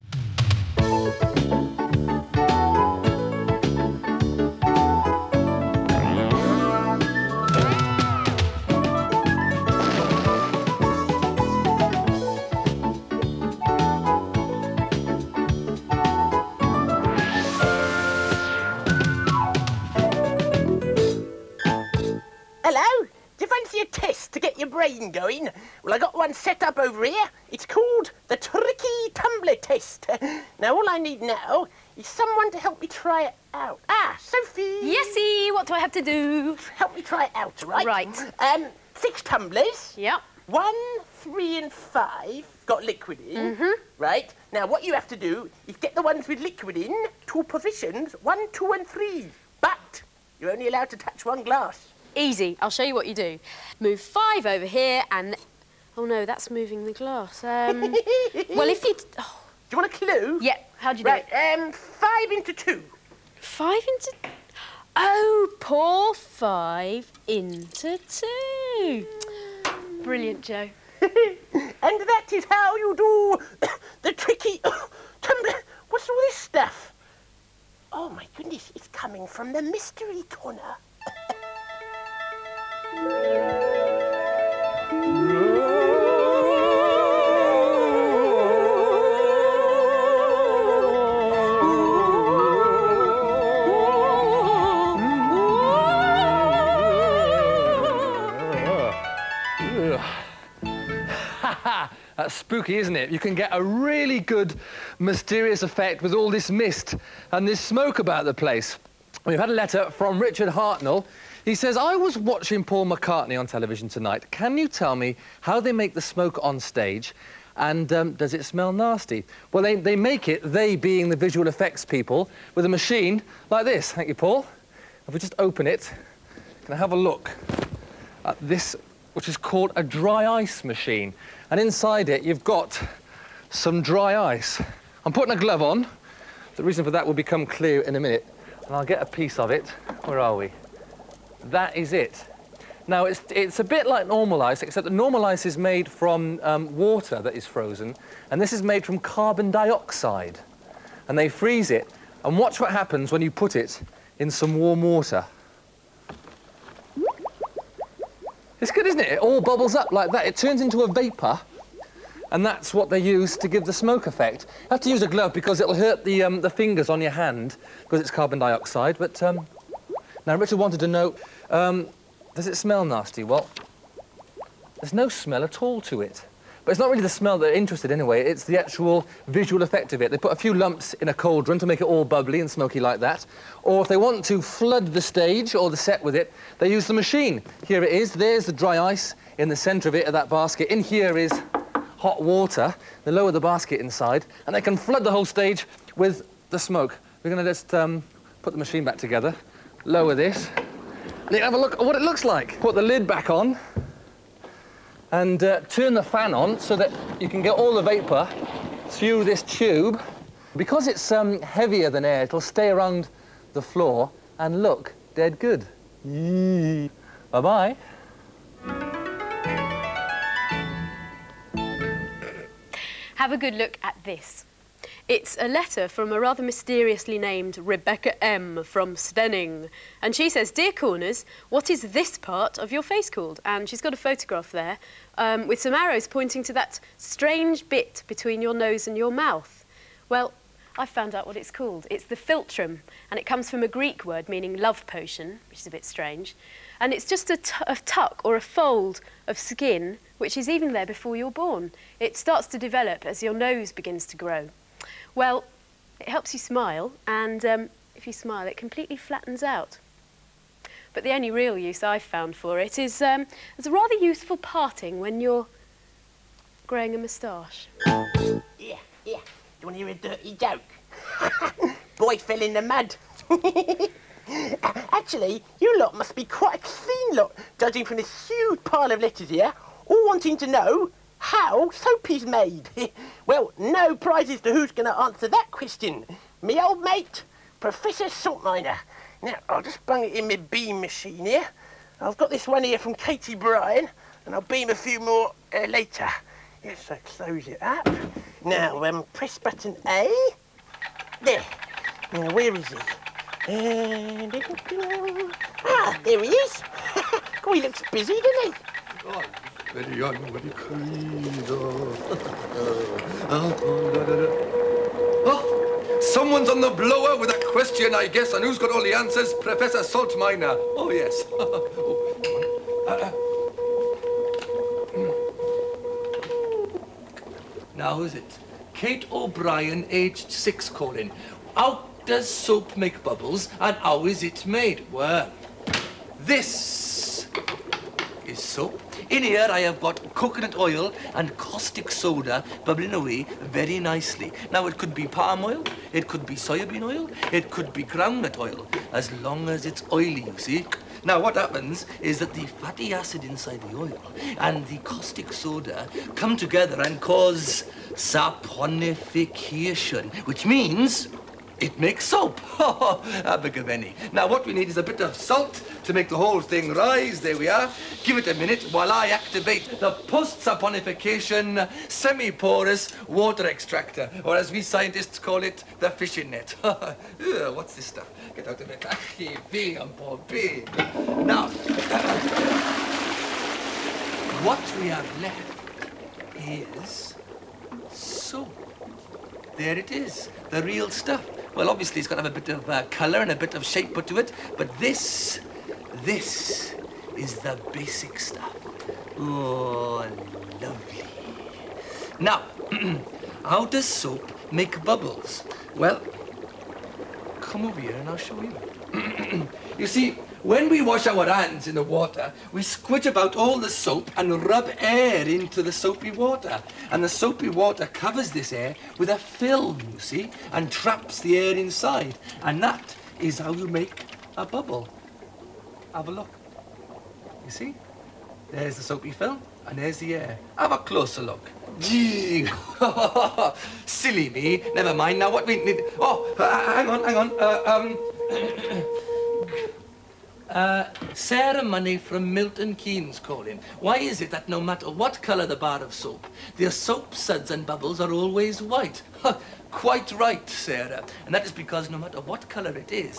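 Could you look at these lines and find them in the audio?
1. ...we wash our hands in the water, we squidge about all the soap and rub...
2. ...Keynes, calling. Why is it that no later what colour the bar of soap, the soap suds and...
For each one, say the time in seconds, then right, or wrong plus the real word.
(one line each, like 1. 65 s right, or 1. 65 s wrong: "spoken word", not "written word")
1. 410 s right
2. 442 s wrong: "matter", not "later".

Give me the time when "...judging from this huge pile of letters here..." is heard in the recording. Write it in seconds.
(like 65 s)
277 s.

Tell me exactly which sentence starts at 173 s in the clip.
Well, there's no smell at all to it.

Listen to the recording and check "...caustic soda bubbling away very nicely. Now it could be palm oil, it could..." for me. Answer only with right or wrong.
right.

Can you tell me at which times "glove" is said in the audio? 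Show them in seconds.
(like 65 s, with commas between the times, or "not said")
135 s, 165 s.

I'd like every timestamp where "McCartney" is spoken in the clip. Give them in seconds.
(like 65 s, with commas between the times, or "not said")
112 s.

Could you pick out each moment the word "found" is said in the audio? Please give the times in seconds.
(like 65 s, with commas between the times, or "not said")
240 s, 262 s.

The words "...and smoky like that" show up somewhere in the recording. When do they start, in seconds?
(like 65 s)
182 s.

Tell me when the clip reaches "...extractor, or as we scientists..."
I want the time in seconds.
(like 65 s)
373 s.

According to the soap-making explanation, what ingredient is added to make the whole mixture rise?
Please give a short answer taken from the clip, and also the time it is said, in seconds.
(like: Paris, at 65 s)
salt, at 365 s.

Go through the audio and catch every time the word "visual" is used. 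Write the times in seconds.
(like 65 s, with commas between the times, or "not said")
121 s, 179 s.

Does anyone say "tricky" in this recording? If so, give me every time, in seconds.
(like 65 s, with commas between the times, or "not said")
28 s, 74 s.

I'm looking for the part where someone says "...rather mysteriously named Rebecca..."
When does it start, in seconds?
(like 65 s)
226 s.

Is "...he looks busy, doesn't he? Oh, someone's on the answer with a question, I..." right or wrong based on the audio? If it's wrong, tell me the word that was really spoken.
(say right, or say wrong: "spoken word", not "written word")
wrong: "blower", not "answer".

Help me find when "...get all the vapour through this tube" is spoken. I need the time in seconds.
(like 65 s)
207 s.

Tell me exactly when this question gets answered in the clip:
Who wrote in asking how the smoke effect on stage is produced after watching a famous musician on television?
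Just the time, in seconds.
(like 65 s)
110 s.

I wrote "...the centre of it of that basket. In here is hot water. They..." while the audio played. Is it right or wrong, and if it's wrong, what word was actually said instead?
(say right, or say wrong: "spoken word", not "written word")
right.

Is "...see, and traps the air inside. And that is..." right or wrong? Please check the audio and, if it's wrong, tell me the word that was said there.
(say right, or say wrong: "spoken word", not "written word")
right.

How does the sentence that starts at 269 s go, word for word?
You want to hear a dirty joke?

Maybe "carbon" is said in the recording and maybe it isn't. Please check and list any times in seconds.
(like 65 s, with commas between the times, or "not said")
148 s, 168 s.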